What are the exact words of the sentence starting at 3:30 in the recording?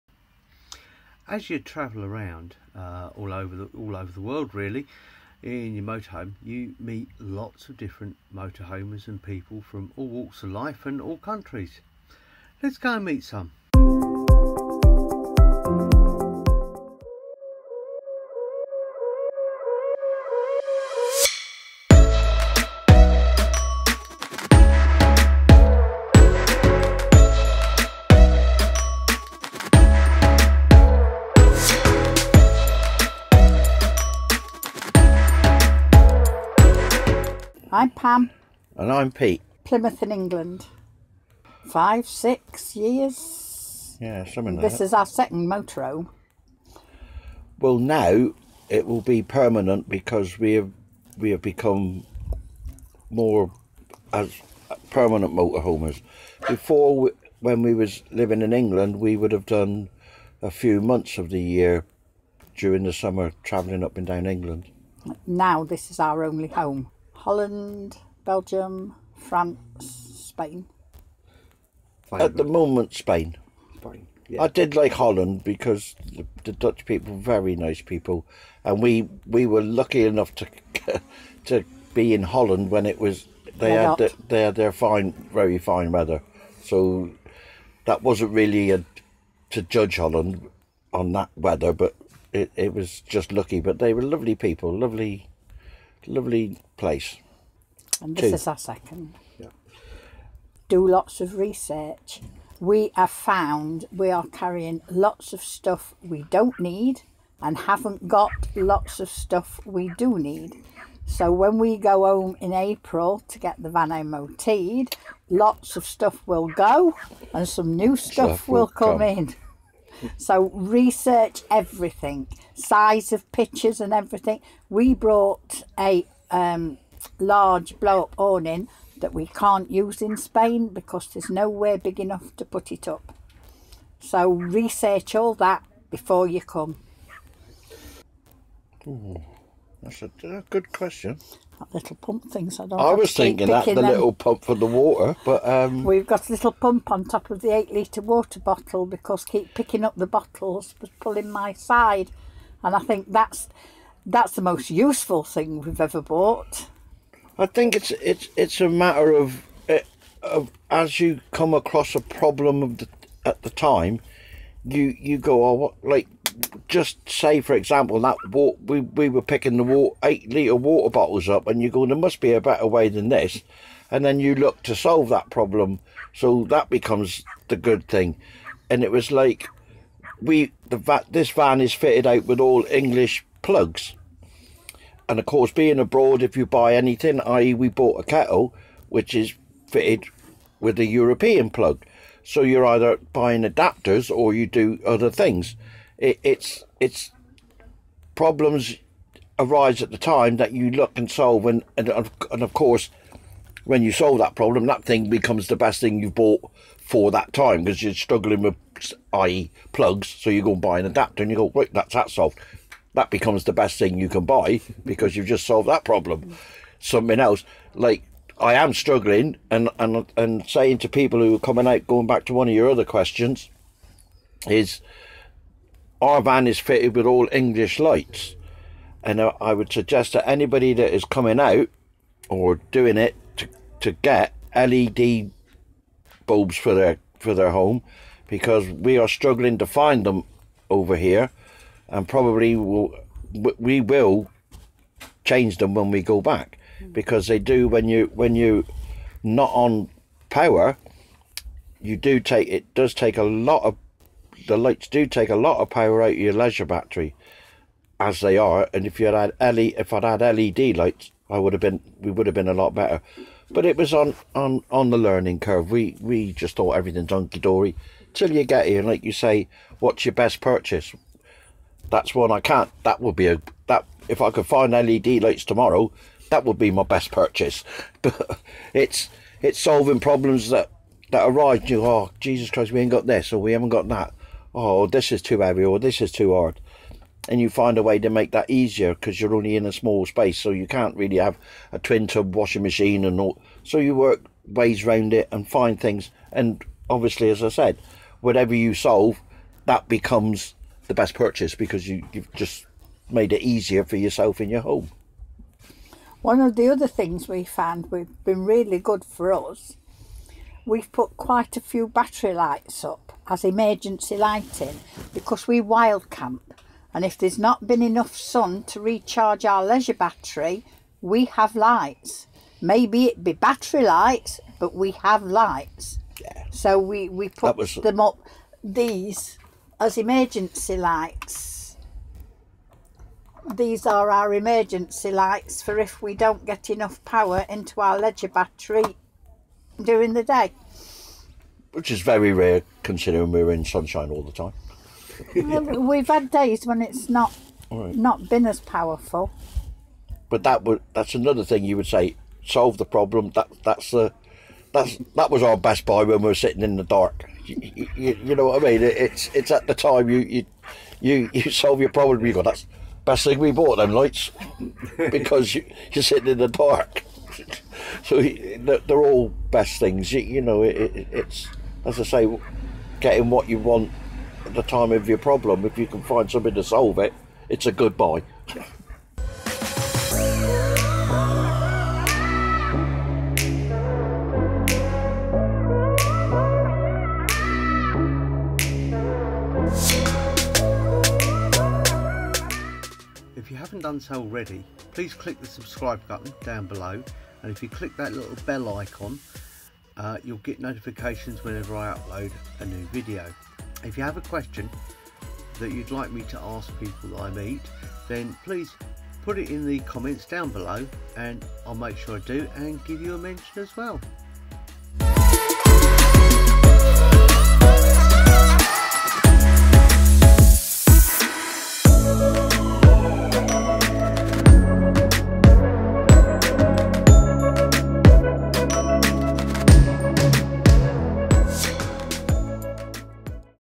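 So you go and buy an adapter, and you go, right, that's that solved.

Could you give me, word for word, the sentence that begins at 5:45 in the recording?
We've had days when it's not right.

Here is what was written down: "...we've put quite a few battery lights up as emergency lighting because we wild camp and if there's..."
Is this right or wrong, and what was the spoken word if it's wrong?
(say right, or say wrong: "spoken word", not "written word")
right.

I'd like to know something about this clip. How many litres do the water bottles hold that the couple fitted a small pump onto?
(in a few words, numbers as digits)
8.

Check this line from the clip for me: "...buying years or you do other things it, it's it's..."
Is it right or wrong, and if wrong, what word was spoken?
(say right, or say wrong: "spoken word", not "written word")
wrong: "adapters", not "years".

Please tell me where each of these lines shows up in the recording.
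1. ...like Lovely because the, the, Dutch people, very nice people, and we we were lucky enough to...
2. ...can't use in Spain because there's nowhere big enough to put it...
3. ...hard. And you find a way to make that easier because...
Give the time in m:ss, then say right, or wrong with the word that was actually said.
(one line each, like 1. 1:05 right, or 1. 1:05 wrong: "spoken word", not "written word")
1. 1:14 wrong: "Holland", not "Lovely"
2. 2:09 right
3. 4:46 right.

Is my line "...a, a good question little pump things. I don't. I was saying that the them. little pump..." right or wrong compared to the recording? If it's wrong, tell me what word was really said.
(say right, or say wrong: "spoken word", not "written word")
wrong: "thinking", not "saying".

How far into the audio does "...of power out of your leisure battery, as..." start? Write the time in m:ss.
4:15.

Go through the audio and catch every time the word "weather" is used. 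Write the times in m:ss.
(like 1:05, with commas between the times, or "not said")
1:25, 1:31.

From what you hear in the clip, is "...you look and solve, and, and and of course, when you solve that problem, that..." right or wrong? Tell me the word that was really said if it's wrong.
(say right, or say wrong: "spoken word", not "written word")
right.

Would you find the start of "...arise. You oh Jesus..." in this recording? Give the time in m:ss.
4:41.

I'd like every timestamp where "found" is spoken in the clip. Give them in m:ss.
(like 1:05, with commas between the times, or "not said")
1:43, 5:07.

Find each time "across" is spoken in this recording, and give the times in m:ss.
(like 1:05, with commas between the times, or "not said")
2:41.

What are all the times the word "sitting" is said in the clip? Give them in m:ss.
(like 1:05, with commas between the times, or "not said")
5:56, 6:06.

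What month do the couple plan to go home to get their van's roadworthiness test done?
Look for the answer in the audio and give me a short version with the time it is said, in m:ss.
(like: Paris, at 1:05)
April, at 1:52.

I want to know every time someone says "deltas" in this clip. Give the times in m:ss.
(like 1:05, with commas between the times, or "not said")
not said.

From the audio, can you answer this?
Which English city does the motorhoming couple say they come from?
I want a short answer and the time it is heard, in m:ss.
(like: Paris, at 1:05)
Plymouth, at 0:39.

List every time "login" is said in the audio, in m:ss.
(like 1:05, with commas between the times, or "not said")
not said.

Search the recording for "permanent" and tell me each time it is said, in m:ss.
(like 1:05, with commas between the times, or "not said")
0:49, 0:54.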